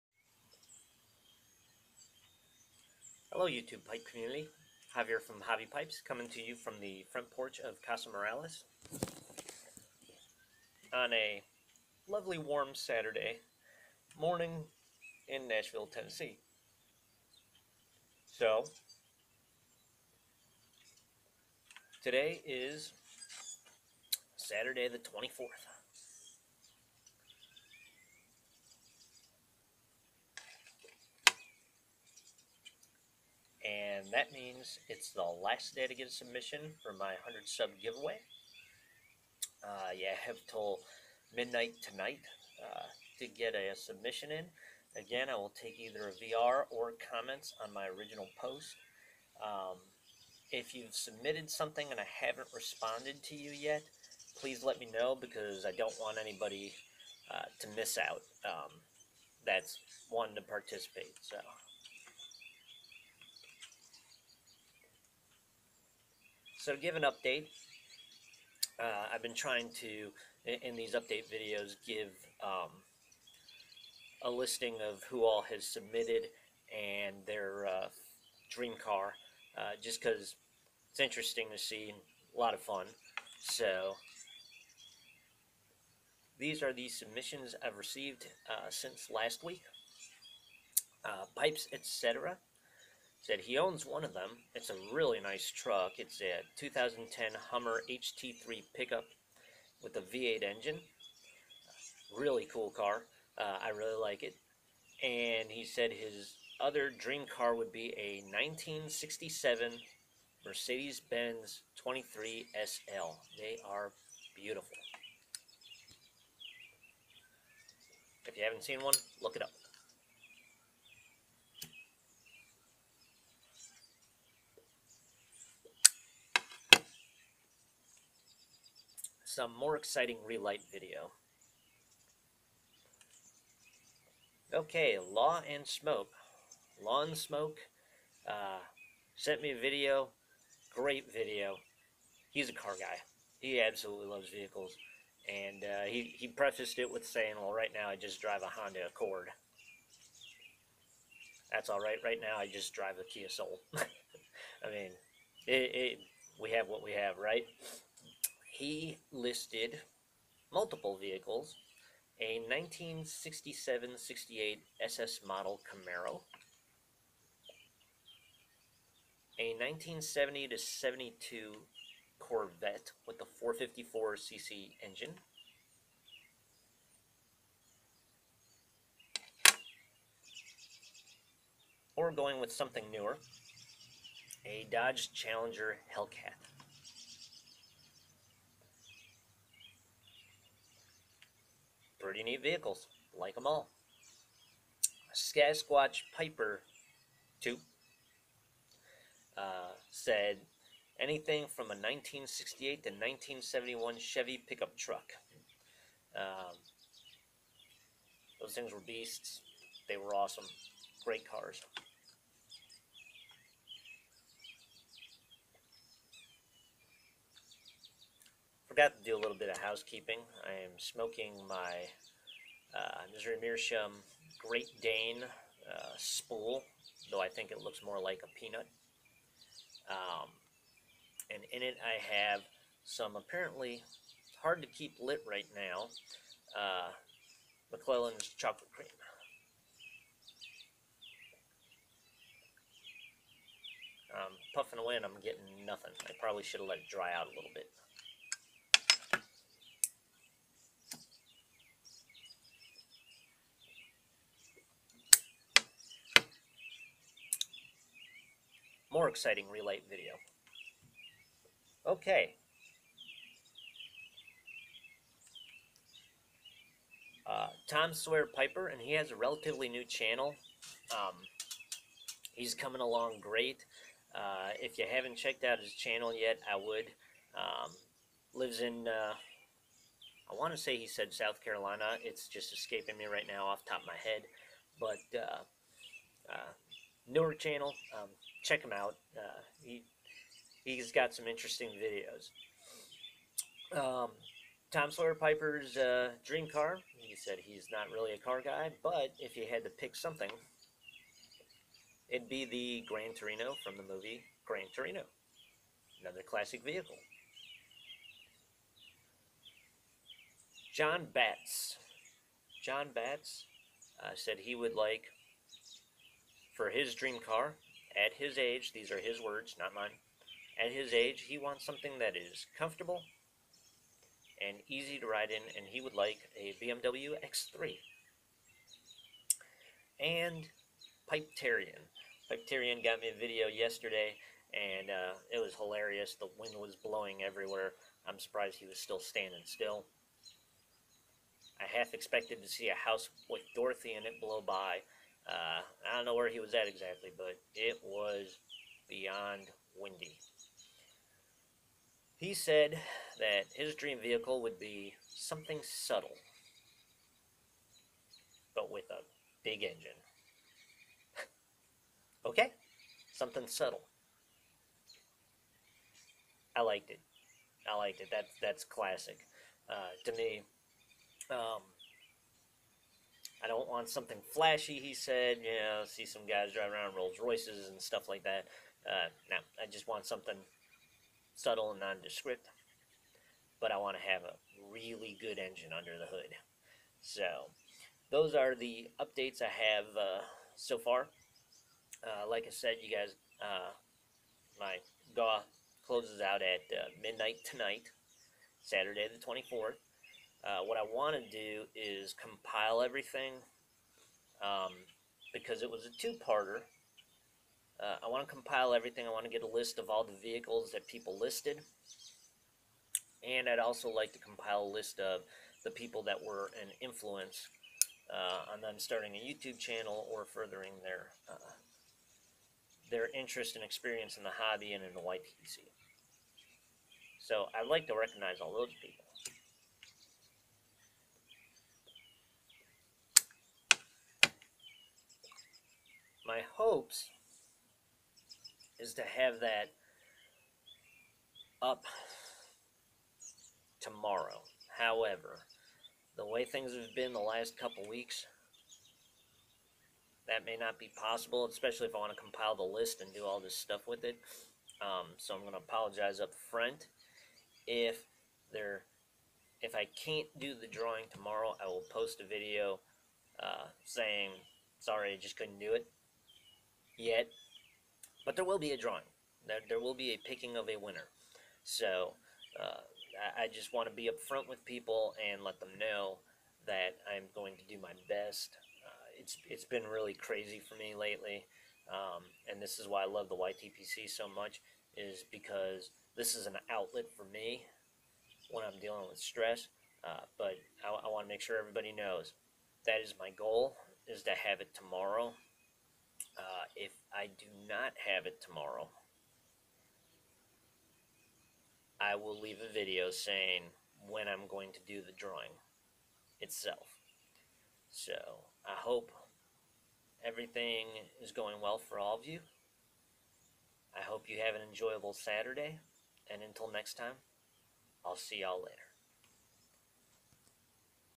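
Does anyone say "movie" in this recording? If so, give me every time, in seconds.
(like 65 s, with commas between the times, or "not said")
303 s.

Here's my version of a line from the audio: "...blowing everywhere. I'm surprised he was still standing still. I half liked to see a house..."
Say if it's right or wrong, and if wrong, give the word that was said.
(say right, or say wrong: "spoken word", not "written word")
wrong: "expected", not "liked".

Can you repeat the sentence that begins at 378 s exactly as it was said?
Uh, no, I just want something subtle and nondescript.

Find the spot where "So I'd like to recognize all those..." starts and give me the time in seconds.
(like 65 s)
427 s.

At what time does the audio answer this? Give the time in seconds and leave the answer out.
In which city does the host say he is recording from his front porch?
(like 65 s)
15 s.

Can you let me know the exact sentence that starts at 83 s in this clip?
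So these are the submissions I've received uh, since last week.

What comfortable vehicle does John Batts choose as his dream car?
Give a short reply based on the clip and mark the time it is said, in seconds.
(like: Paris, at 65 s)
BMW X3, at 326 s.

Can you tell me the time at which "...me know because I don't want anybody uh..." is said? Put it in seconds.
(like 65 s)
54 s.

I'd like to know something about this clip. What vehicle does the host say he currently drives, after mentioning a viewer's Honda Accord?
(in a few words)
Kia Soul.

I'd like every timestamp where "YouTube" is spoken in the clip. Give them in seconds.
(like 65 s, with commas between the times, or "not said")
3 s, 419 s.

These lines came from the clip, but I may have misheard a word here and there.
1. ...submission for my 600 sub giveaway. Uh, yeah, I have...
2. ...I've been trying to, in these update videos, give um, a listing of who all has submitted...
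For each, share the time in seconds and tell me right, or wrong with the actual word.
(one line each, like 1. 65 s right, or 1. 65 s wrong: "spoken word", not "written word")
1. 36 s wrong: "100", not "600"
2. 69 s right.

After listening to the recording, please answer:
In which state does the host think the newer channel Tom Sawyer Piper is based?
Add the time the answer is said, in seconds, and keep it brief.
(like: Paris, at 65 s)
South Carolina, at 281 s.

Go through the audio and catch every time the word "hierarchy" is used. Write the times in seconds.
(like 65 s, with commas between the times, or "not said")
not said.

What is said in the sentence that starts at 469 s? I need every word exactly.
There, there will be a picking of a winner.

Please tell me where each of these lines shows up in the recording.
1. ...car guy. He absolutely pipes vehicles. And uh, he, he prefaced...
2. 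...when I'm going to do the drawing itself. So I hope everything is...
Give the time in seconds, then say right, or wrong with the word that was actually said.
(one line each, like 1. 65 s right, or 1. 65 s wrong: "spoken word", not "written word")
1. 142 s wrong: "loves", not "pipes"
2. 504 s right.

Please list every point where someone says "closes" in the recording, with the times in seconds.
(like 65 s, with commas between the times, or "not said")
395 s.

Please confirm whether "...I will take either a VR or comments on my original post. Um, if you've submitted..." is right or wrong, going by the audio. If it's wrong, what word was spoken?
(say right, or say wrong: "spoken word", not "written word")
right.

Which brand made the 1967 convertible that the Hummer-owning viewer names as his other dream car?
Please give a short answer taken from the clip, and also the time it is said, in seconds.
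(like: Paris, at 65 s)
Mercedes Benz, at 110 s.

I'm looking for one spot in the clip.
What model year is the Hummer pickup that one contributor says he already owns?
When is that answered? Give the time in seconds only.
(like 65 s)
96 s.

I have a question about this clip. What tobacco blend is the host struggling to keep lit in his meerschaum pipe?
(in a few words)
McClelland's chocolate cream.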